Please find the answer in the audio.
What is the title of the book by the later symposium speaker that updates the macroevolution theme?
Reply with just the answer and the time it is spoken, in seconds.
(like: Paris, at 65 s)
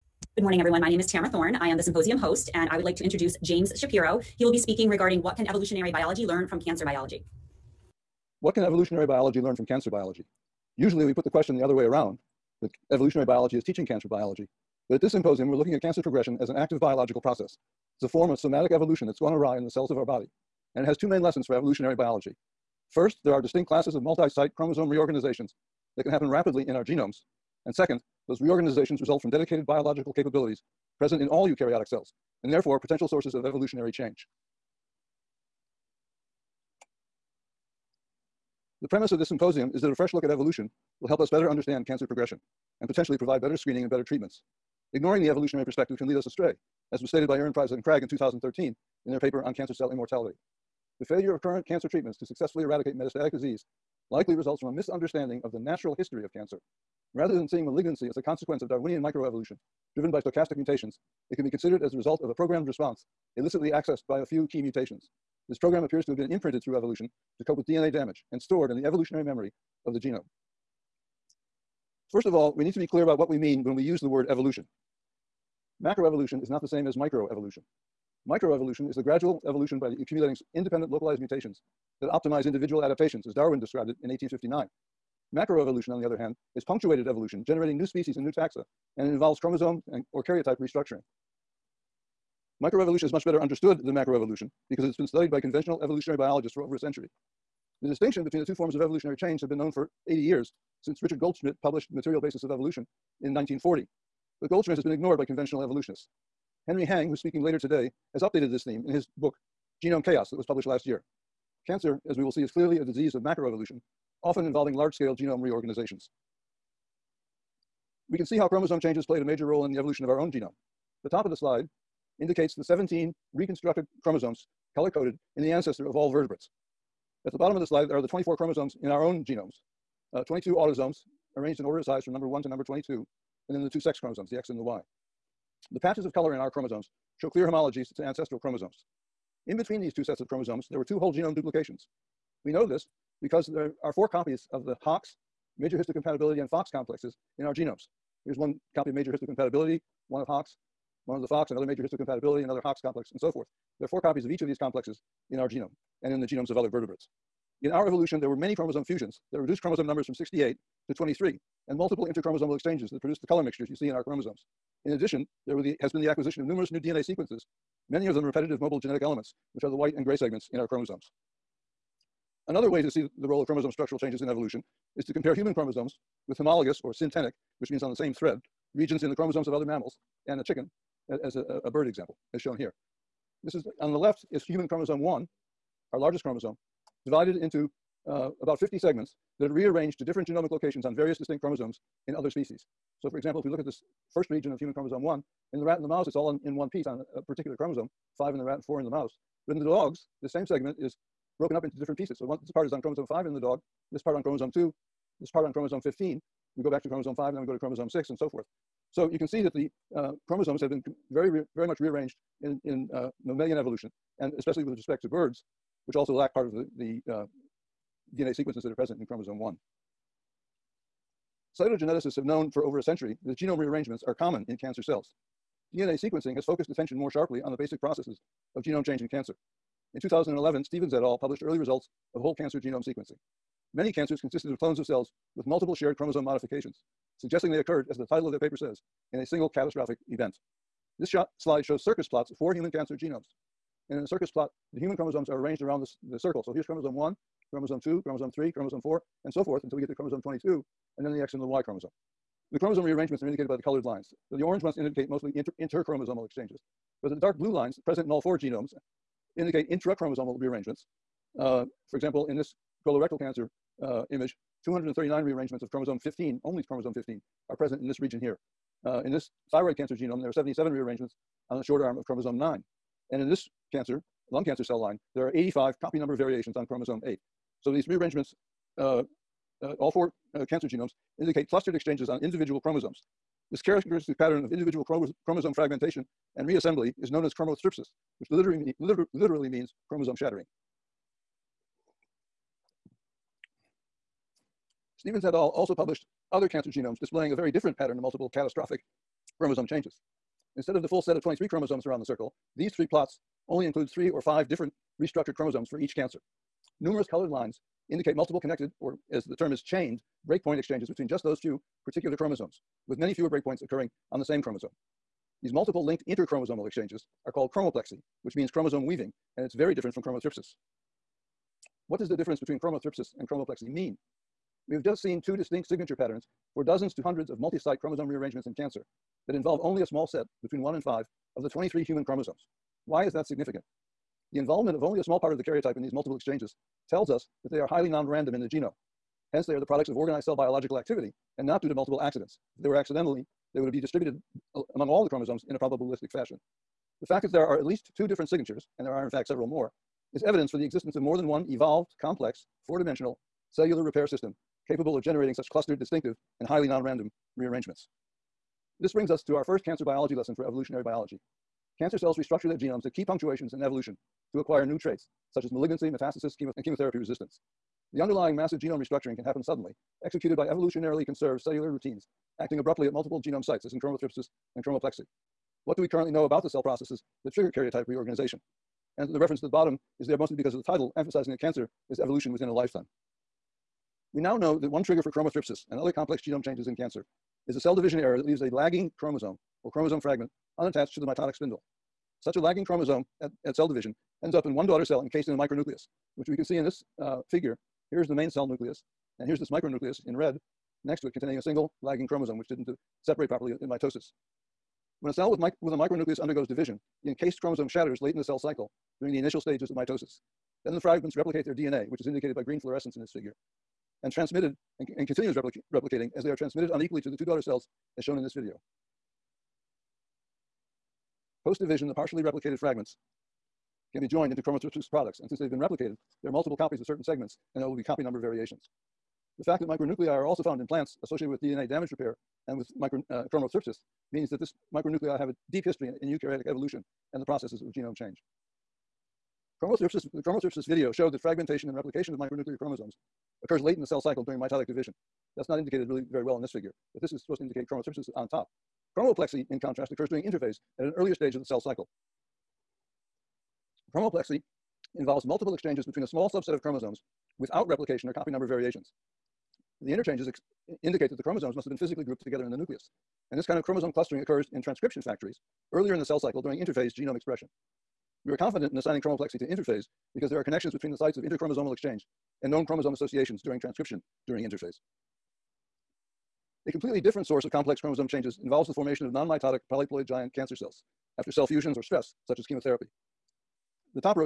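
Genome Chaos, at 109 s.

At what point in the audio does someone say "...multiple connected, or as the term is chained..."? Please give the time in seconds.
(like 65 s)
308 s.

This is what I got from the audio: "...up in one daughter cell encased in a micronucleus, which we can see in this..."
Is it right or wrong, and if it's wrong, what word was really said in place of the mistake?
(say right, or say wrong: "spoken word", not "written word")
right.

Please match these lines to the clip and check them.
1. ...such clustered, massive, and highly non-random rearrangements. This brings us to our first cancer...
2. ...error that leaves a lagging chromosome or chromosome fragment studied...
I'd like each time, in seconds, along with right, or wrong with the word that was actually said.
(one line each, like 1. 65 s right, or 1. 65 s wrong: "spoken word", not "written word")
1. 355 s wrong: "distinctive", not "massive"
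2. 387 s wrong: "unattached", not "studied".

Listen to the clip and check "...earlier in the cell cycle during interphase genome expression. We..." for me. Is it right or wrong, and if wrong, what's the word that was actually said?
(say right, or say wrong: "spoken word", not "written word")
right.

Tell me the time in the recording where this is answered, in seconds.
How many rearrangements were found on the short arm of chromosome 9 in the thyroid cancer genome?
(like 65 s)
270 s.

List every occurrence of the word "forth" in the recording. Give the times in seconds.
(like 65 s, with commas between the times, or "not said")
153 s, 208 s, 249 s.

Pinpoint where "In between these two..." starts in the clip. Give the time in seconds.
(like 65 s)
139 s.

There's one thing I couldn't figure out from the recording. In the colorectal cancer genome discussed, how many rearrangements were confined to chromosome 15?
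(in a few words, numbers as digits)
239.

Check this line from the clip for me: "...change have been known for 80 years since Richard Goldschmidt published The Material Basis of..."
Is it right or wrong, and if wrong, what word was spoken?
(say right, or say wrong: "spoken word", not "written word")
right.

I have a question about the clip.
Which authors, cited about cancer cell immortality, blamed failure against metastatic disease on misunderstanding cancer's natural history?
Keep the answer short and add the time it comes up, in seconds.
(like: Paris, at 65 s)
Erenpreisa and Cragg, at 47 s.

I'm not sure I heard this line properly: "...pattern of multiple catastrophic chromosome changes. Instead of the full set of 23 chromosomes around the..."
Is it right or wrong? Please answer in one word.
right.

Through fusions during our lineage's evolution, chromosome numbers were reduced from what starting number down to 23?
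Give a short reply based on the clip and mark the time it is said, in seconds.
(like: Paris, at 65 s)
68, at 160 s.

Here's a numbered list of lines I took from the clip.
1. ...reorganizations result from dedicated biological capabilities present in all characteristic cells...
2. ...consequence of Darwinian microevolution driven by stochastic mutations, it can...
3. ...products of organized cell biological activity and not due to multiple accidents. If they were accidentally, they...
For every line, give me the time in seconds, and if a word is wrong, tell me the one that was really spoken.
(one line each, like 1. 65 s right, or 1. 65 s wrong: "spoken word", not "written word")
1. 28 s wrong: "eukaryotic", not "characteristic"
2. 58 s right
3. 339 s right.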